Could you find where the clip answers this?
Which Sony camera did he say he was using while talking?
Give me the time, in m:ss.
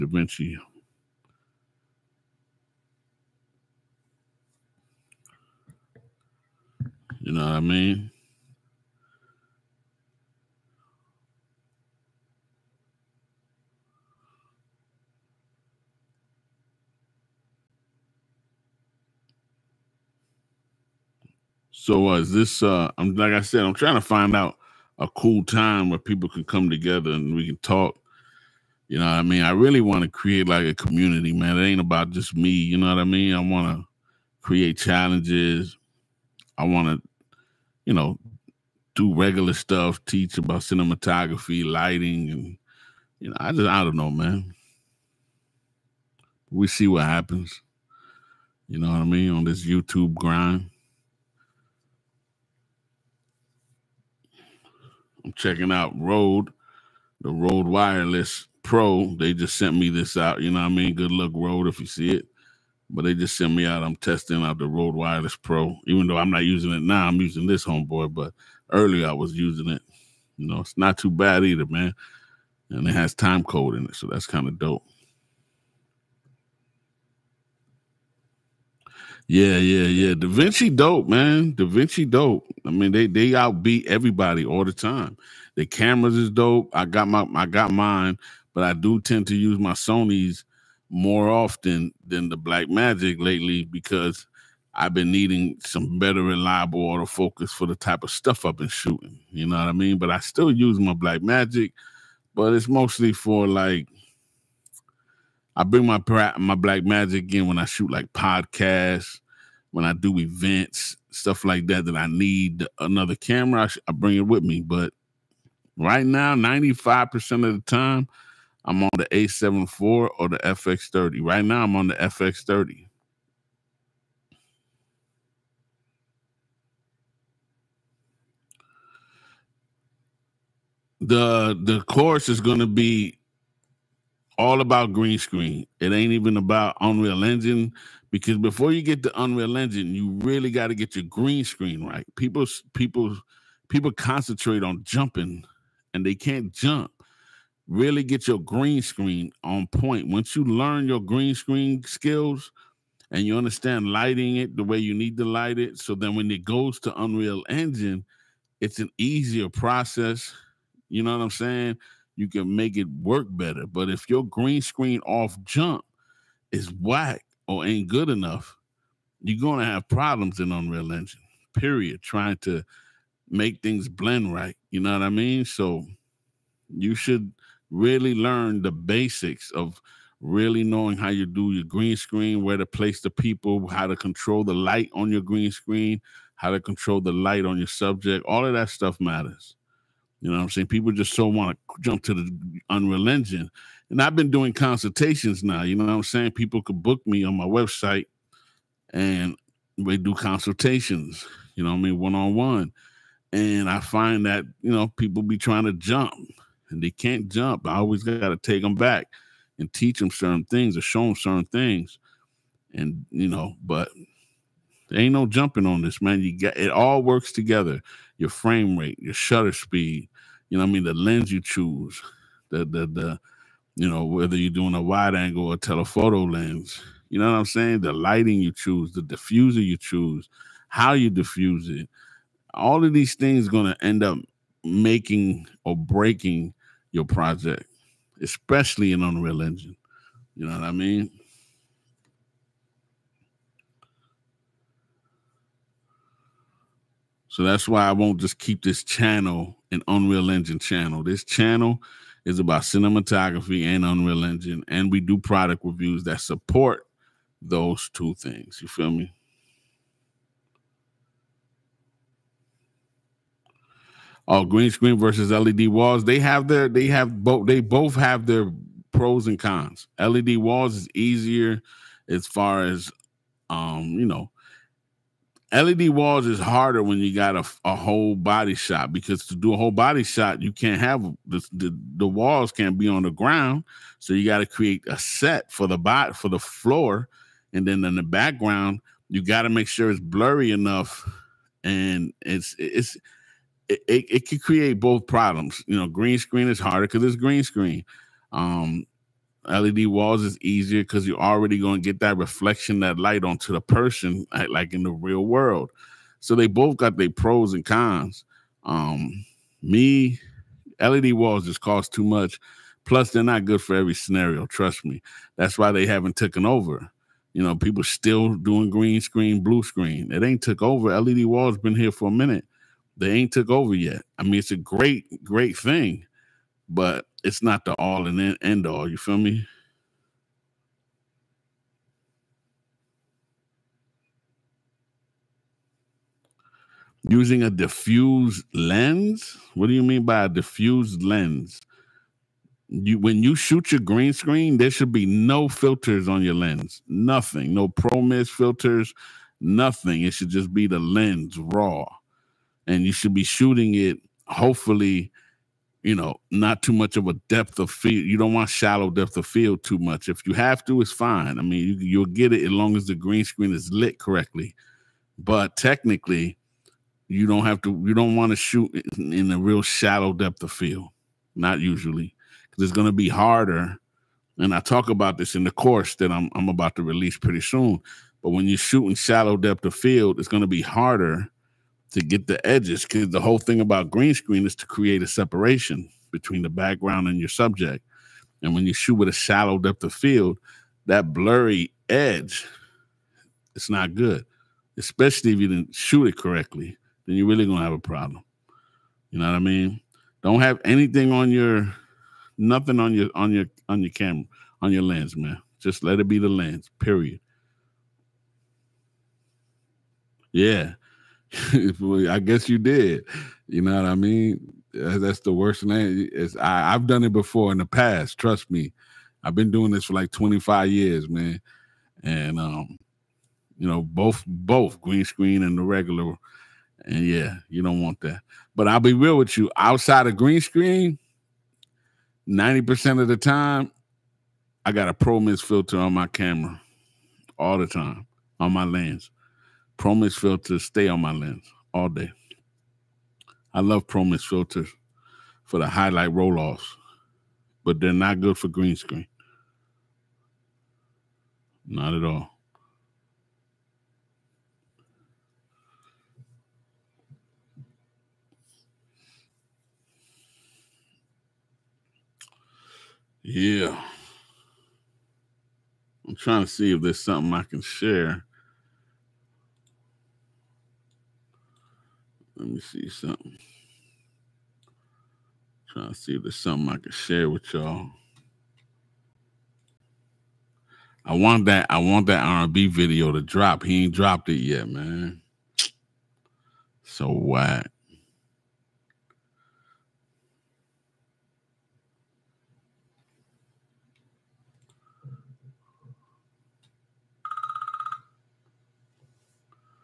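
2:01.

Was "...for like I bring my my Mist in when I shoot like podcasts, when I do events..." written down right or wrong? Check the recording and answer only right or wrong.
wrong.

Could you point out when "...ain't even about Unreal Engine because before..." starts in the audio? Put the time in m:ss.
2:15.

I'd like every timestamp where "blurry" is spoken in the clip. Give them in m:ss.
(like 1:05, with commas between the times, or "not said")
4:49, 6:31.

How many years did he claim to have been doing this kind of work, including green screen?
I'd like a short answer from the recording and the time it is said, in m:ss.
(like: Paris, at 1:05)
25, at 7:00.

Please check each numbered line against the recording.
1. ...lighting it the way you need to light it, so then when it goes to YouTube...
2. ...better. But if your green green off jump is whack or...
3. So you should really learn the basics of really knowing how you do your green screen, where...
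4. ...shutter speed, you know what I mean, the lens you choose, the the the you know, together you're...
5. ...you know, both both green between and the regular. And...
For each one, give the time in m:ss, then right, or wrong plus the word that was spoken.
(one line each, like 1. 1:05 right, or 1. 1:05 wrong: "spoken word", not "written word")
1. 2:33 wrong: "Unreal", not "YouTube"
2. 2:43 wrong: "screen", not "green"
3. 2:55 right
4. 3:39 wrong: "whether", not "together"
5. 7:03 wrong: "screen", not "between".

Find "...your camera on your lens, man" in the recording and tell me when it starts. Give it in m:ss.
6:43.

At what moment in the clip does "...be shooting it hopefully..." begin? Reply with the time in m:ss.
5:53.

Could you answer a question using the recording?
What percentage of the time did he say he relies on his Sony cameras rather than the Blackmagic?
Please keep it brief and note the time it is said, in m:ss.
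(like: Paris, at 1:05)
95, at 1:56.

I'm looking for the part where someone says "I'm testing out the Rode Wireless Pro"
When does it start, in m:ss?
1:03.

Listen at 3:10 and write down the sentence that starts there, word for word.
People just so want to jump to the Unreal Engine.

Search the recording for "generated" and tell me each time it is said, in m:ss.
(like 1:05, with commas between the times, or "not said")
not said.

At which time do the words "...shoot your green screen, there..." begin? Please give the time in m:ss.
5:43.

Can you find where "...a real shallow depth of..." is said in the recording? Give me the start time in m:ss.
6:09.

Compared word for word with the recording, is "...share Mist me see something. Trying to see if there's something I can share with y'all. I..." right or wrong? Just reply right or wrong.
wrong.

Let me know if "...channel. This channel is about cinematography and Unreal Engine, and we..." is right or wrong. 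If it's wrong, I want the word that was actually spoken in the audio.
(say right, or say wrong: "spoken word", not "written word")
right.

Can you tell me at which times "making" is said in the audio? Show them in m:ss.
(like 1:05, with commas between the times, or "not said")
3:54.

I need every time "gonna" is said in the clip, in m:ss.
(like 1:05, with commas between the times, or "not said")
2:49, 3:53, 6:37.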